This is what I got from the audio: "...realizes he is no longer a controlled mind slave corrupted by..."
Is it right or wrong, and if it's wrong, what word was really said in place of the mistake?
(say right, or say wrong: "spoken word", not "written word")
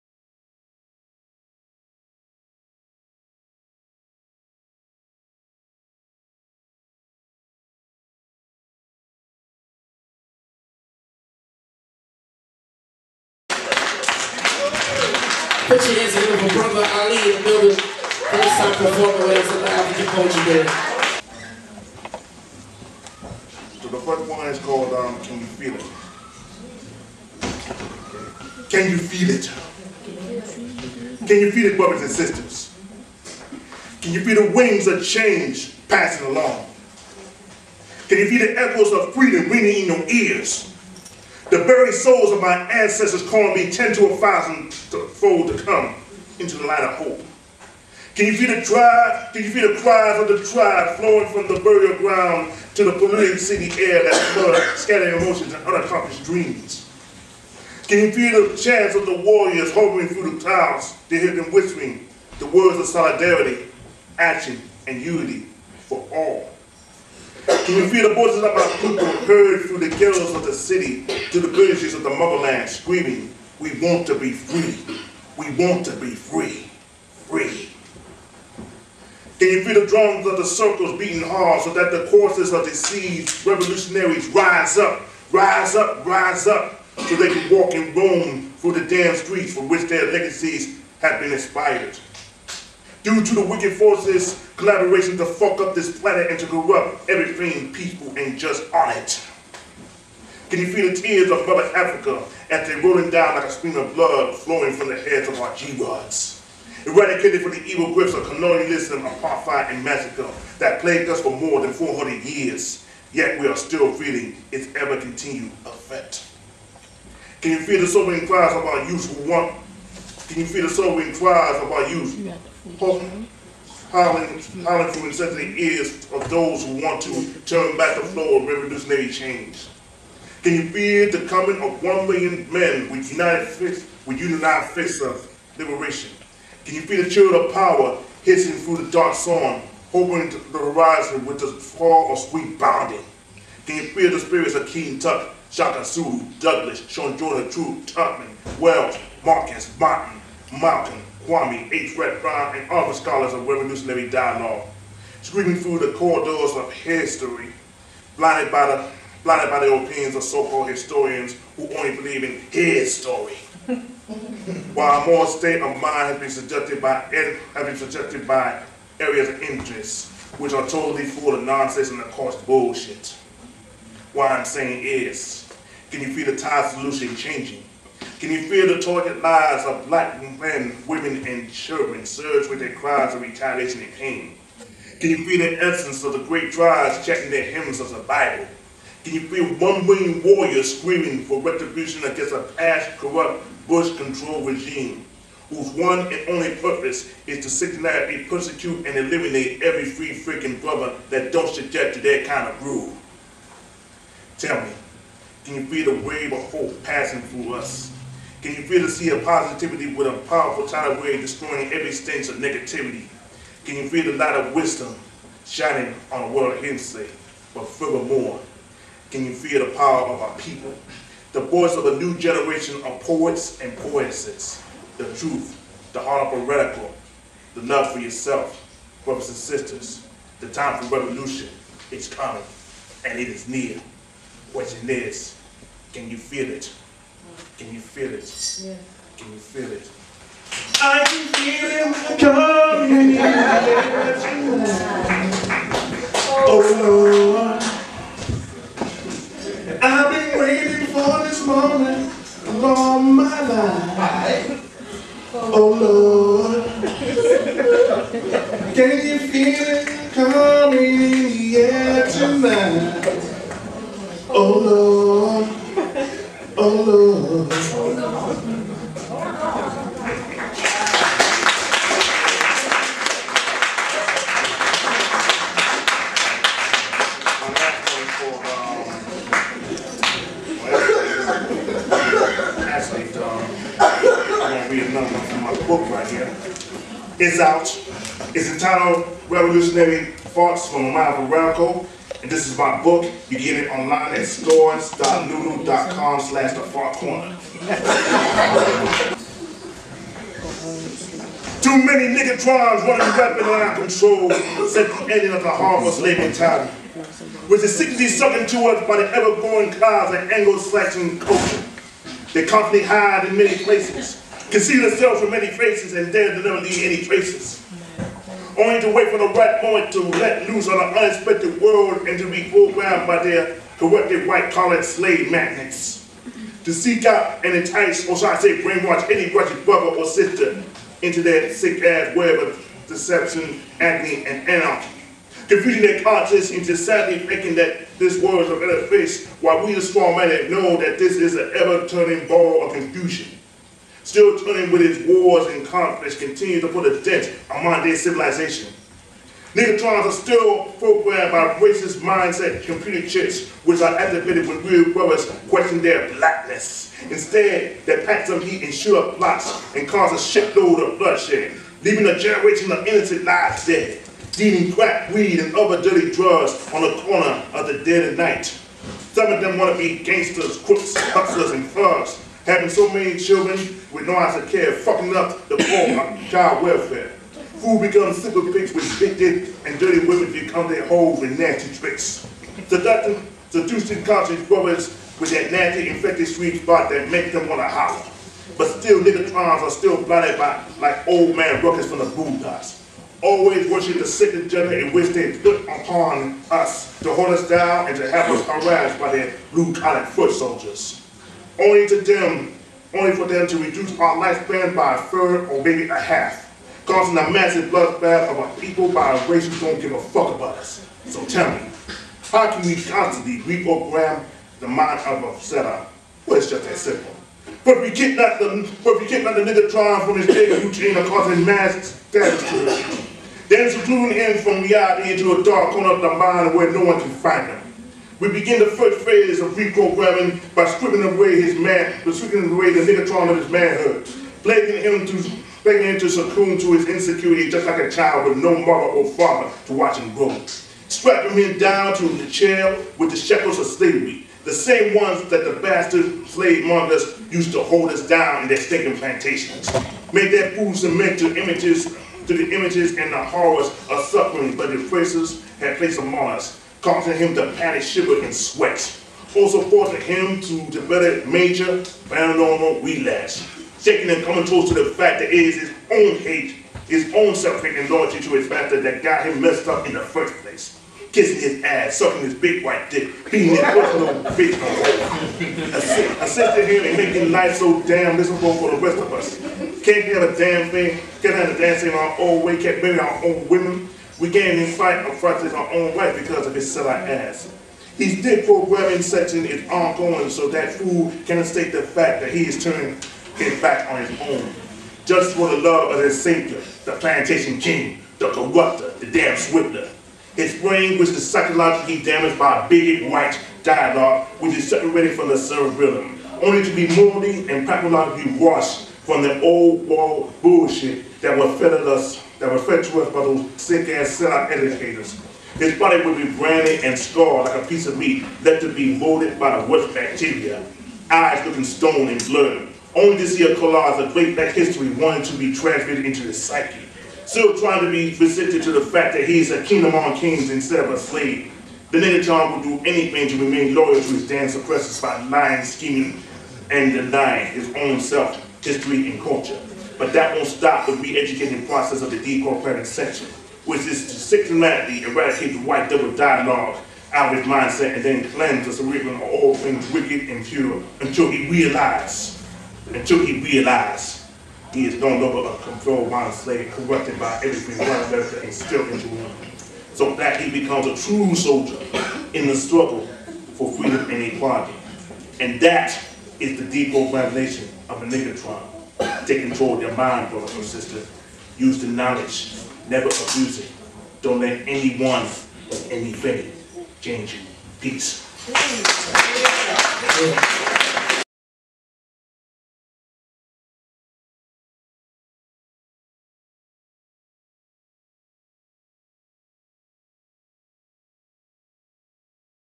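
right.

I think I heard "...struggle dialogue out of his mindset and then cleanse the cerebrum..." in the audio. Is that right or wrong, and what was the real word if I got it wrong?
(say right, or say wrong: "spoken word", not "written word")
wrong: "double", not "struggle".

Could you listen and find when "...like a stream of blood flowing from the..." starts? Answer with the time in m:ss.
1:43.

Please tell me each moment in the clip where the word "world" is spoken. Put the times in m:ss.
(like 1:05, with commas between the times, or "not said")
3:36, 5:21, 5:38, 8:29.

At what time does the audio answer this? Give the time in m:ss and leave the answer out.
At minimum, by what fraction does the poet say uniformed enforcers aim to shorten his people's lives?
6:44.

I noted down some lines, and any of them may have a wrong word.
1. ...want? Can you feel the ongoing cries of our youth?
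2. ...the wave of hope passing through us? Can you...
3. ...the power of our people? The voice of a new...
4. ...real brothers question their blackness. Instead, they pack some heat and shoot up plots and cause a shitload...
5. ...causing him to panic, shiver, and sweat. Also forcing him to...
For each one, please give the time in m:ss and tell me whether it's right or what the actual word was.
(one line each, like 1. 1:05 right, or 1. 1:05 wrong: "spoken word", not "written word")
1. 1:59 wrong: "sobering", not "ongoing"
2. 3:25 right
3. 3:39 right
4. 5:54 right
5. 7:36 right.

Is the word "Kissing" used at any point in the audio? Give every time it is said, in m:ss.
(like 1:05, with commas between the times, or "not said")
7:51.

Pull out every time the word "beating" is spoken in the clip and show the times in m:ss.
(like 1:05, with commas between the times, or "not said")
1:20, 7:53.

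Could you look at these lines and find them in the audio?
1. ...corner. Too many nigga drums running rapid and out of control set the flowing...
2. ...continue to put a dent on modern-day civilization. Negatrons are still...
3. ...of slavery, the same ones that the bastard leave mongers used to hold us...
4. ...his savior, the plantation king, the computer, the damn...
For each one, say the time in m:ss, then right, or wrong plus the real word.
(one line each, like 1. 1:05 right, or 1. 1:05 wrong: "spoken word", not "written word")
1. 4:56 wrong: "ending", not "flowing"
2. 5:46 right
3. 7:23 wrong: "slave", not "leave"
4. 8:16 wrong: "corrupter", not "computer".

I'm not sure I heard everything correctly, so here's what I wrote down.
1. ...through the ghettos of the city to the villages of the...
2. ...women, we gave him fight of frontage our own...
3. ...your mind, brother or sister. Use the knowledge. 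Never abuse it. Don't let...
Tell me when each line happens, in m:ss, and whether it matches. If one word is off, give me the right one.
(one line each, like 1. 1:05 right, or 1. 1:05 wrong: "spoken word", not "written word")
1. 1:09 right
2. 8:03 right
3. 9:29 right.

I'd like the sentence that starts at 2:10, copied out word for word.
Can you fear the coming of one million men with united fists, with united fists of liberation?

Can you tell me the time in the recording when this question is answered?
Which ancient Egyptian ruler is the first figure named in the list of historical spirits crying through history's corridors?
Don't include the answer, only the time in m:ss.
2:24.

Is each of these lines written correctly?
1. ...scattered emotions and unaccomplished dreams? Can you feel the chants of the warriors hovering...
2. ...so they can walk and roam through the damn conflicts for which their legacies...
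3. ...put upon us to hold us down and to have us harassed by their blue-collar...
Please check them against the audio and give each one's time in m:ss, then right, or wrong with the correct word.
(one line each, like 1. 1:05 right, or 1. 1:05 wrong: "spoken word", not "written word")
1. 0:54 right
2. 1:26 wrong: "streets", not "conflicts"
3. 6:35 right.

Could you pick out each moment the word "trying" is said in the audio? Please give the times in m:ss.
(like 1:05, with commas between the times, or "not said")
6:59, 8:47.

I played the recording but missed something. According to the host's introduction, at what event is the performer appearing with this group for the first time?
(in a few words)
African Culture Day.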